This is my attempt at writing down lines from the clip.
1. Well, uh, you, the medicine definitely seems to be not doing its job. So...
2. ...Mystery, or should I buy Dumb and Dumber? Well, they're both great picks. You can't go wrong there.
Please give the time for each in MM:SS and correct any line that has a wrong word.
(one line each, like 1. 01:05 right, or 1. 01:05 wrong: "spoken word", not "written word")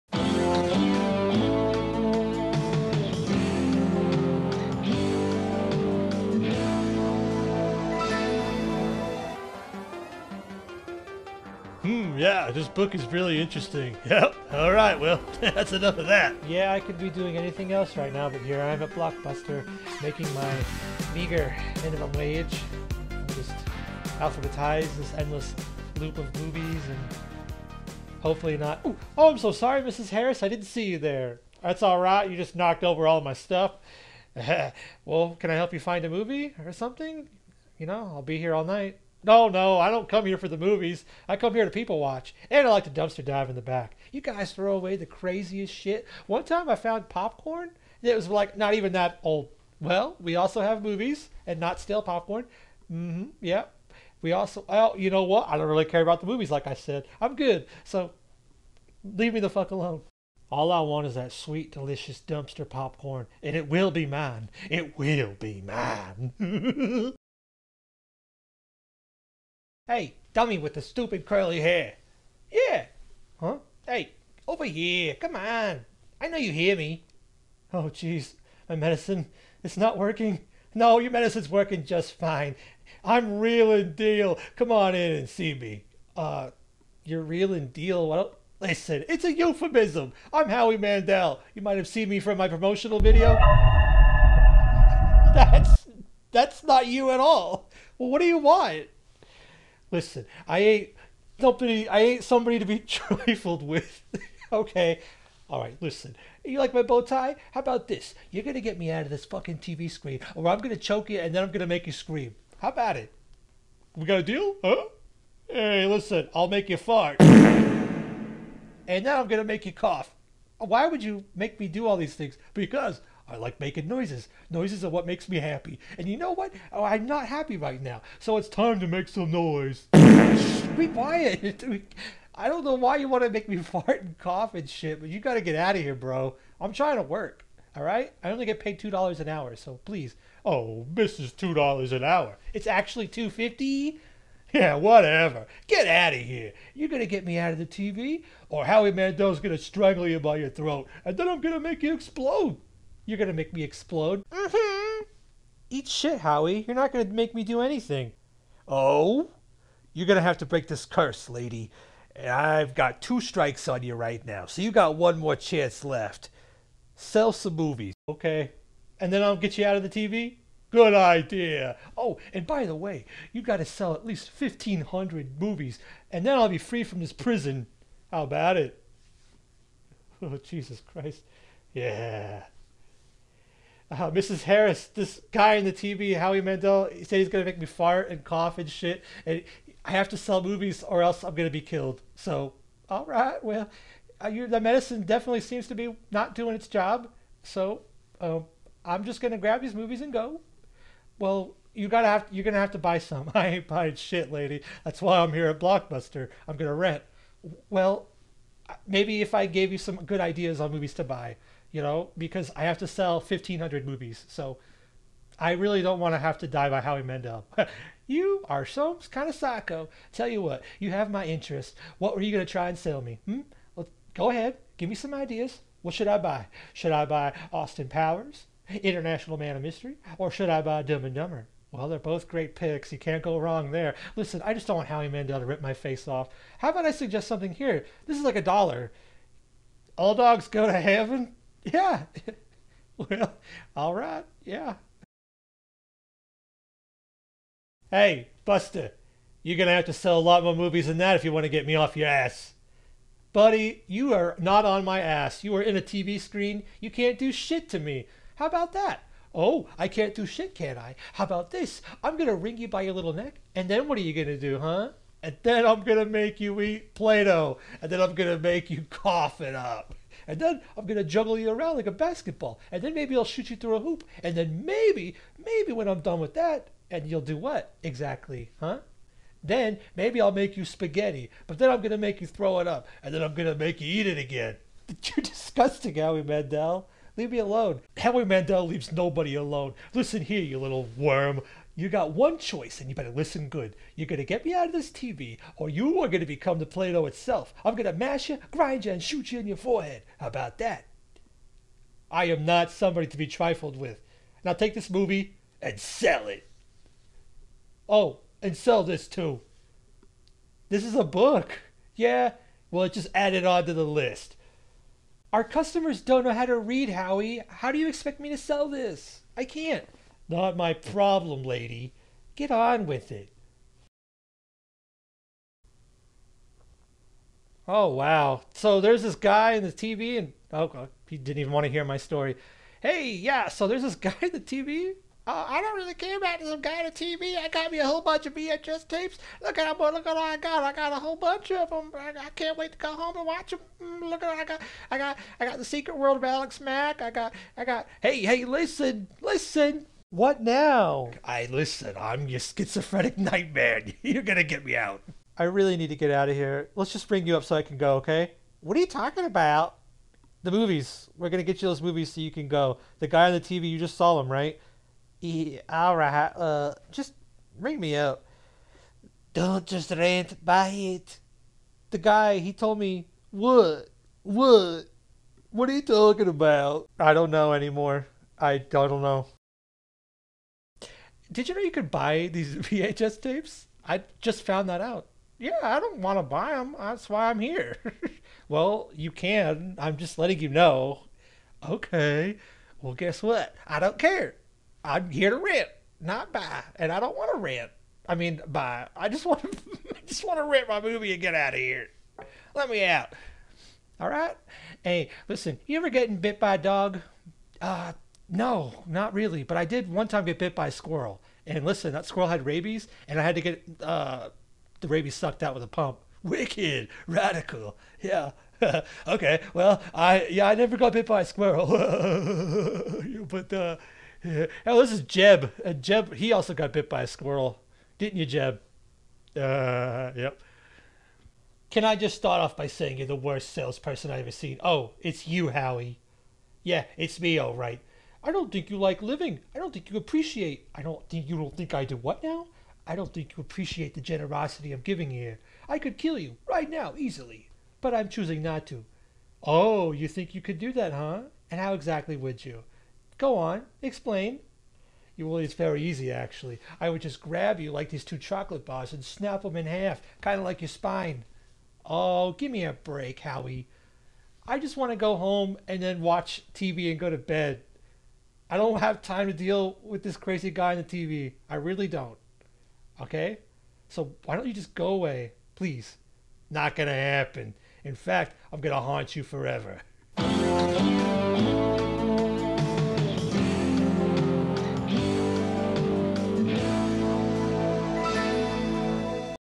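1. 03:13 right
2. 03:49 right.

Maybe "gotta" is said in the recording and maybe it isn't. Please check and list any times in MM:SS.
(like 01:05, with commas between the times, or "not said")
03:21.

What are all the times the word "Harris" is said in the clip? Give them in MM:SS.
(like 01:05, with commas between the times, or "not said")
00:30, 03:04.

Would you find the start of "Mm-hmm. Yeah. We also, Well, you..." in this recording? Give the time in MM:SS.
00:52.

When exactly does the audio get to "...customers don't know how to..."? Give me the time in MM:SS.
05:15.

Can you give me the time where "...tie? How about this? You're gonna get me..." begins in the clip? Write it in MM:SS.
01:47.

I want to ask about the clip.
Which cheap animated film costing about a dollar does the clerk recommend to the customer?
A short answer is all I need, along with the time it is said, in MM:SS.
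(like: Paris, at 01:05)
All Dogs Go to Heaven, at 03:59.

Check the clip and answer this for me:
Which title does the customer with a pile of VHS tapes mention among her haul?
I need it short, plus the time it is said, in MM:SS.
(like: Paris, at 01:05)
The Secret World of Alex Mack, at 05:45.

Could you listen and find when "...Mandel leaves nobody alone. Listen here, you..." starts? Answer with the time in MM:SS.
04:48.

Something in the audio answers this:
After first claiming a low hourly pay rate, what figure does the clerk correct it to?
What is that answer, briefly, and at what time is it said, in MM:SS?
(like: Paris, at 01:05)
250, at 02:23.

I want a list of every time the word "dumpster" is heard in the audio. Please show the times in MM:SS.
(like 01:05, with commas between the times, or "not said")
00:42, 01:02.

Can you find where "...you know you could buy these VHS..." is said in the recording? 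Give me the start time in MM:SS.
06:21.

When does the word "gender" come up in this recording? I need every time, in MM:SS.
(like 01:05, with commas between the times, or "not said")
not said.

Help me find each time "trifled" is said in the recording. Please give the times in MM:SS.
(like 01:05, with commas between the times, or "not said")
01:42, 05:03.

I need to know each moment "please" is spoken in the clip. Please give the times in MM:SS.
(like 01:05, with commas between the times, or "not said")
02:19, 07:55.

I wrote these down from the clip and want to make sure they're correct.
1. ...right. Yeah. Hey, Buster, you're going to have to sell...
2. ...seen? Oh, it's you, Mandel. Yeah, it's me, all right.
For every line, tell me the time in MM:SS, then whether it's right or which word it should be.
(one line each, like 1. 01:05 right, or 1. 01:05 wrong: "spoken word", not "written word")
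1. 04:03 right
2. 07:14 wrong: "Howie", not "Mandel".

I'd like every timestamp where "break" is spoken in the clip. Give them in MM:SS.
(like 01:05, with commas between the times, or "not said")
02:40, 07:42.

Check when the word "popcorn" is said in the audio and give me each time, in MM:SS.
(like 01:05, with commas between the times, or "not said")
00:47, 00:52, 01:02.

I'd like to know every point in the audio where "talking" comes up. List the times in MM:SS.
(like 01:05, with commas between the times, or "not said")
05:58, 06:15.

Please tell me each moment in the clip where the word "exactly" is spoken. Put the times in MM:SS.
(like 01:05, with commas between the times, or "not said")
04:37, 07:31.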